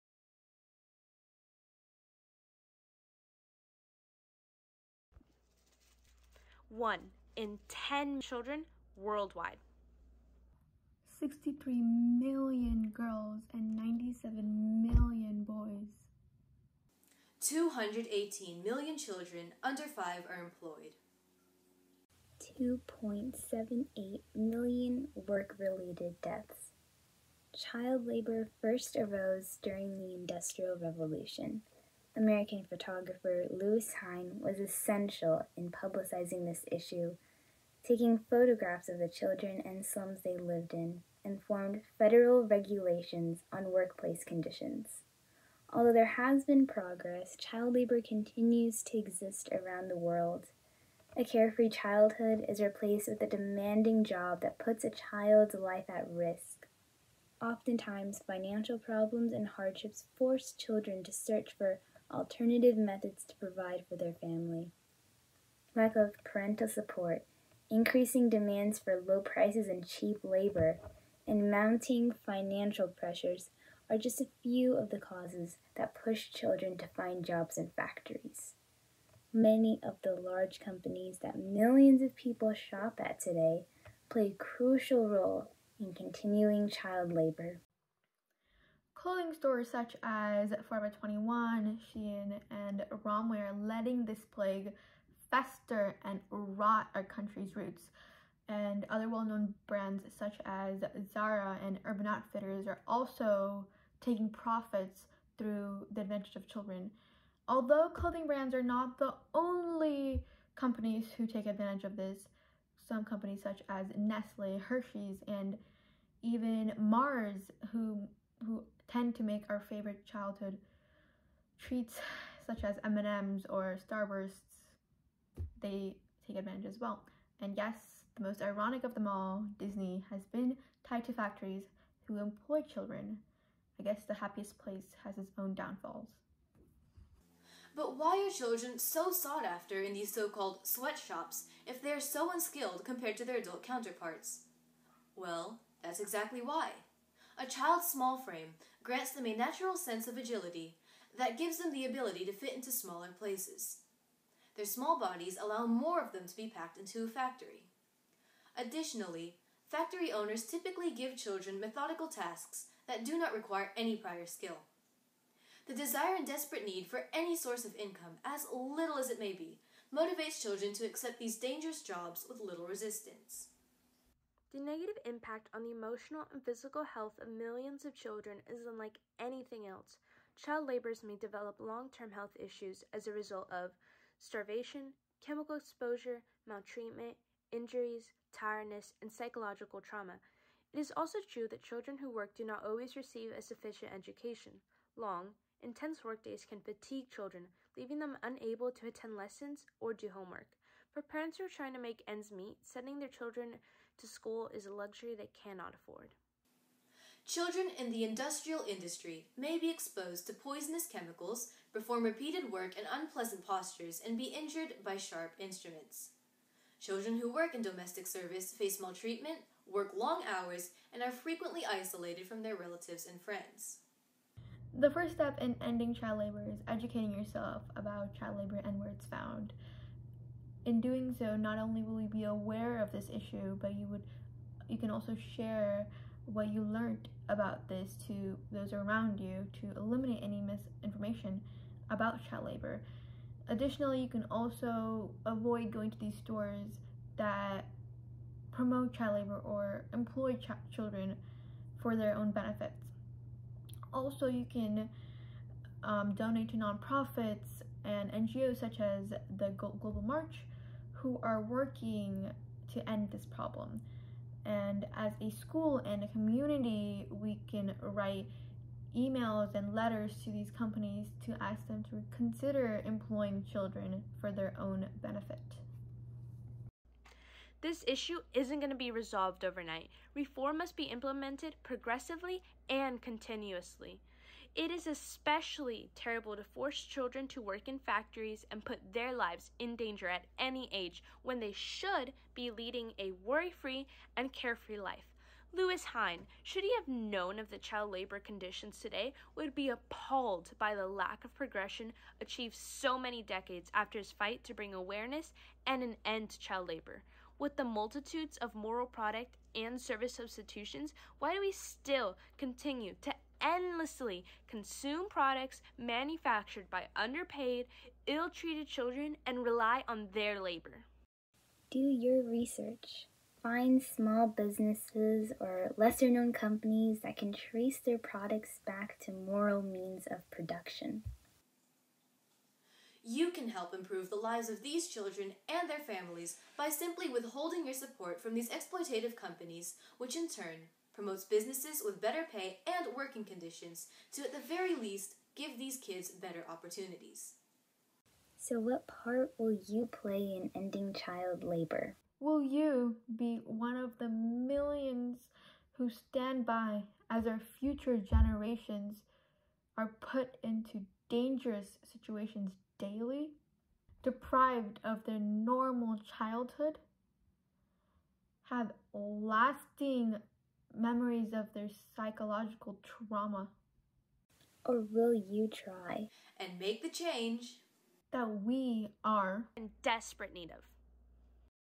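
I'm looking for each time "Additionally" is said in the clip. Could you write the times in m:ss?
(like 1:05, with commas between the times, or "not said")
2:38, 4:03.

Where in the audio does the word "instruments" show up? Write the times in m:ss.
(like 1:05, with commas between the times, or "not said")
3:35.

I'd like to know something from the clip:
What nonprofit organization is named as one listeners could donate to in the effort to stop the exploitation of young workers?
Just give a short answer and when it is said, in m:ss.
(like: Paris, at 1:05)
Global March, at 4:19.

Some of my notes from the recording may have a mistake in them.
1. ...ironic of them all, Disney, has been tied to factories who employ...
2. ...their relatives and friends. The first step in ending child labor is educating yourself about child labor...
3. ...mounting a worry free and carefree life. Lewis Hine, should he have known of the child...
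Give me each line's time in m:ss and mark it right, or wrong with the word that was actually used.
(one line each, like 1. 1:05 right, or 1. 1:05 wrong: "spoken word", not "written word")
1. 2:08 right
2. 3:42 right
3. 4:52 wrong: "leading", not "mounting".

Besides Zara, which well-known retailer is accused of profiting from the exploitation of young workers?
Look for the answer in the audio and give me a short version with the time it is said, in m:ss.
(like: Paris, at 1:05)
Urban Outfitters, at 1:41.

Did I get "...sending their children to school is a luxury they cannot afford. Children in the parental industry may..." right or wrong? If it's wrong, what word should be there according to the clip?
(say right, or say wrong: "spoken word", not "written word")
wrong: "industrial", not "parental".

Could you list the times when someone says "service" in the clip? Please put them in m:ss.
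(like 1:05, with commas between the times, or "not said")
3:38, 5:09.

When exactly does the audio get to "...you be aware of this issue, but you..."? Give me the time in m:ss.
3:52.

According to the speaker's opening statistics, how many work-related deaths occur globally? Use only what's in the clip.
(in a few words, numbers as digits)
2.78 million.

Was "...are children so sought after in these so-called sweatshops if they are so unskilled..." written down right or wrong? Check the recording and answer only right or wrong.
right.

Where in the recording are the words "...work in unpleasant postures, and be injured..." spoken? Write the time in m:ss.
3:32.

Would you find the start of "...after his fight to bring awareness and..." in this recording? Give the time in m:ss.
5:03.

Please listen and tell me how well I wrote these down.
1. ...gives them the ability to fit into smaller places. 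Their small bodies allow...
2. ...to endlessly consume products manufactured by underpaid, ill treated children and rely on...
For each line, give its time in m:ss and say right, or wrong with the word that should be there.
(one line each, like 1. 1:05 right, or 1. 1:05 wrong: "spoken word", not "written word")
1. 2:31 right
2. 5:12 right.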